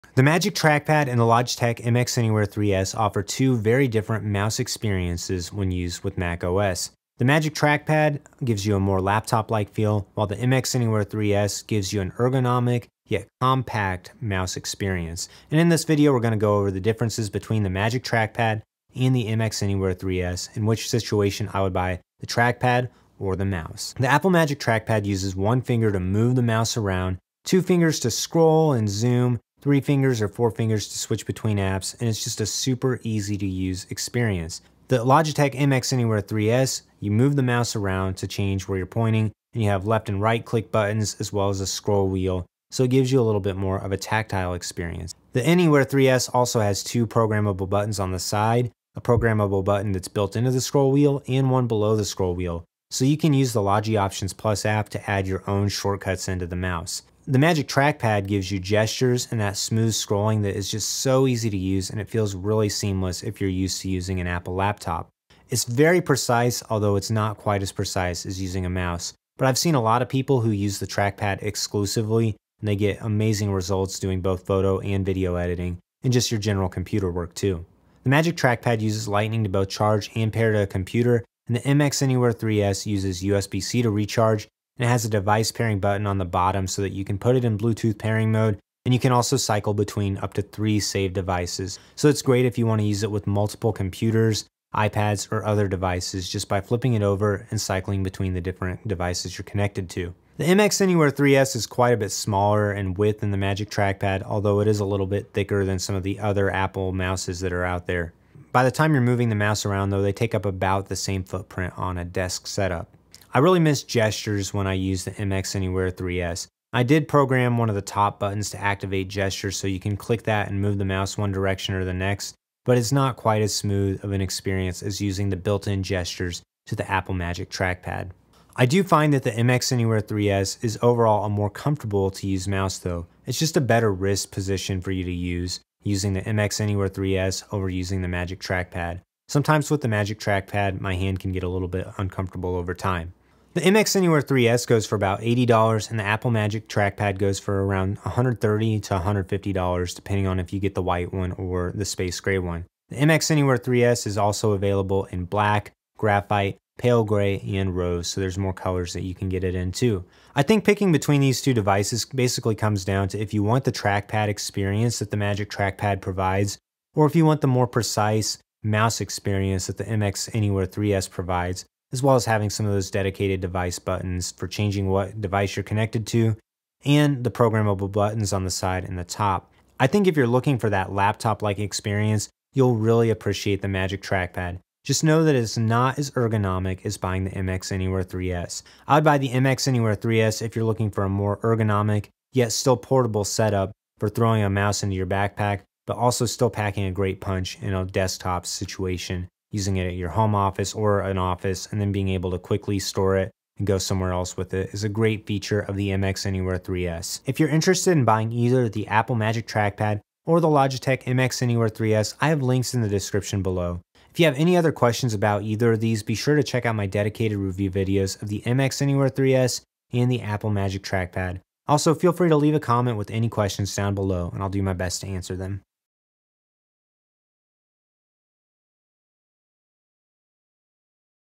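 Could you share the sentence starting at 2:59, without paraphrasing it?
I think if you're looking for that laptop-like experience, you'll really appreciate the Magic Trackpad.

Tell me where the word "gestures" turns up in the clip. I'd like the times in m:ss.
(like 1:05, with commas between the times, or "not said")
0:58, 1:53, 1:59, 2:05.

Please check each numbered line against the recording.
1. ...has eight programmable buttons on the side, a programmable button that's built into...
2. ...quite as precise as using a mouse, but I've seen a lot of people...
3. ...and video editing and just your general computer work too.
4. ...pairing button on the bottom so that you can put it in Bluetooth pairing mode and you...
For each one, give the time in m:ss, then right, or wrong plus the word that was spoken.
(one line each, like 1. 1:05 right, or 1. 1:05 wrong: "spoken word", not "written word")
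1. 0:46 wrong: "two", not "eight"
2. 1:07 right
3. 1:14 right
4. 1:25 right.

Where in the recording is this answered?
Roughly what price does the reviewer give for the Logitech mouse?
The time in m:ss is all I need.
2:25.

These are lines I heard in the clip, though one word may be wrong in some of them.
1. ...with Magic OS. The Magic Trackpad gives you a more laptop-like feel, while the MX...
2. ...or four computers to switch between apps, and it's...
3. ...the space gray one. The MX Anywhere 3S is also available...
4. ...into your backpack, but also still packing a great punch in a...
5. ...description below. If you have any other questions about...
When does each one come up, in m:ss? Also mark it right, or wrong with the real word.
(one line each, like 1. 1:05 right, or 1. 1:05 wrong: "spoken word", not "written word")
1. 0:06 wrong: "Mac", not "Magic"
2. 0:30 wrong: "fingers", not "computers"
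3. 2:31 right
4. 3:14 right
5. 3:32 right.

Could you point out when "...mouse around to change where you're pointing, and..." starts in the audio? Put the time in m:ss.
0:37.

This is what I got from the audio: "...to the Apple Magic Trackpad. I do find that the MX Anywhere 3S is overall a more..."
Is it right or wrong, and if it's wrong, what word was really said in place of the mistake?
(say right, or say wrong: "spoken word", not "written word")
right.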